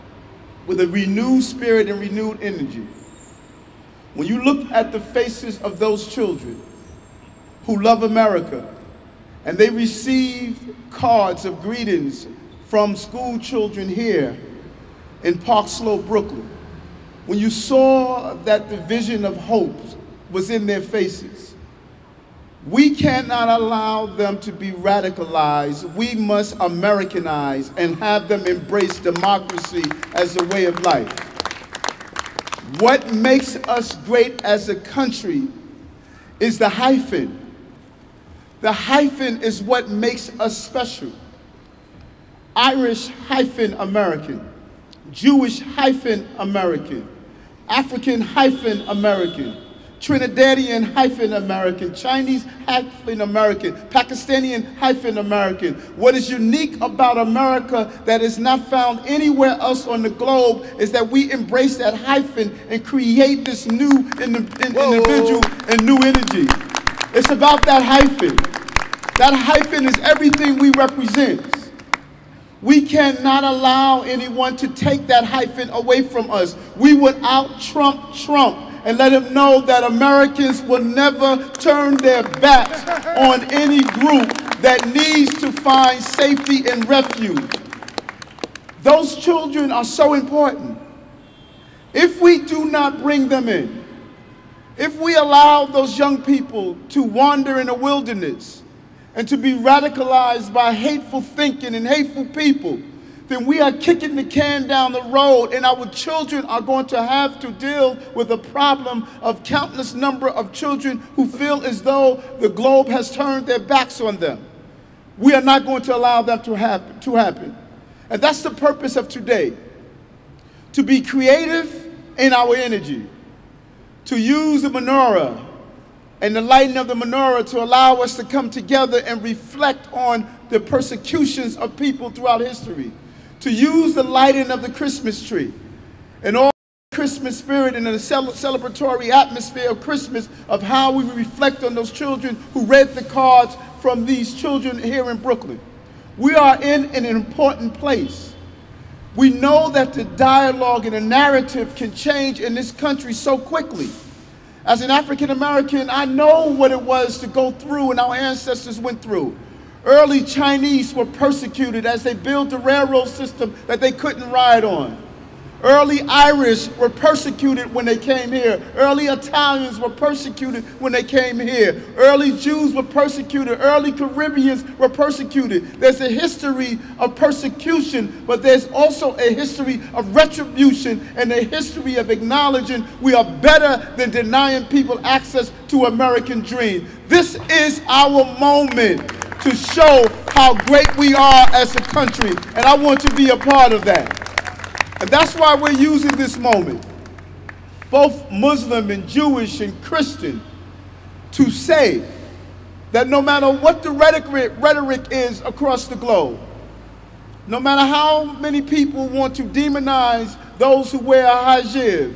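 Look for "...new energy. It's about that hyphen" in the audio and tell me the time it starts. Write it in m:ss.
1:05.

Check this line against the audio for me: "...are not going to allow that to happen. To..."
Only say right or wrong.
right.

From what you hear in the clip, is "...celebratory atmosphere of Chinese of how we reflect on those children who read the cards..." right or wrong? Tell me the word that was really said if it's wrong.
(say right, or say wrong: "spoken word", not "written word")
wrong: "Christmas", not "Chinese".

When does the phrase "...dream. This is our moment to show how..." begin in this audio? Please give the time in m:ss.
3:06.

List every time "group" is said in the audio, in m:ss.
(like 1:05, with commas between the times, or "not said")
1:23.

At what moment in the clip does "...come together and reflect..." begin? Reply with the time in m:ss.
2:08.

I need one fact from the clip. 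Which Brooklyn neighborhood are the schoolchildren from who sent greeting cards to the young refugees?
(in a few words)
Park Slope.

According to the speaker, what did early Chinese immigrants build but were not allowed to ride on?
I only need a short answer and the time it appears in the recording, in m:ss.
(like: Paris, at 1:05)
Railroad system, at 2:42.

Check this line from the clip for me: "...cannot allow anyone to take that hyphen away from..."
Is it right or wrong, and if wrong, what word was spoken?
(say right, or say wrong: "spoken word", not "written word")
right.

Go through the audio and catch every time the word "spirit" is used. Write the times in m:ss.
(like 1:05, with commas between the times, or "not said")
0:01, 2:17.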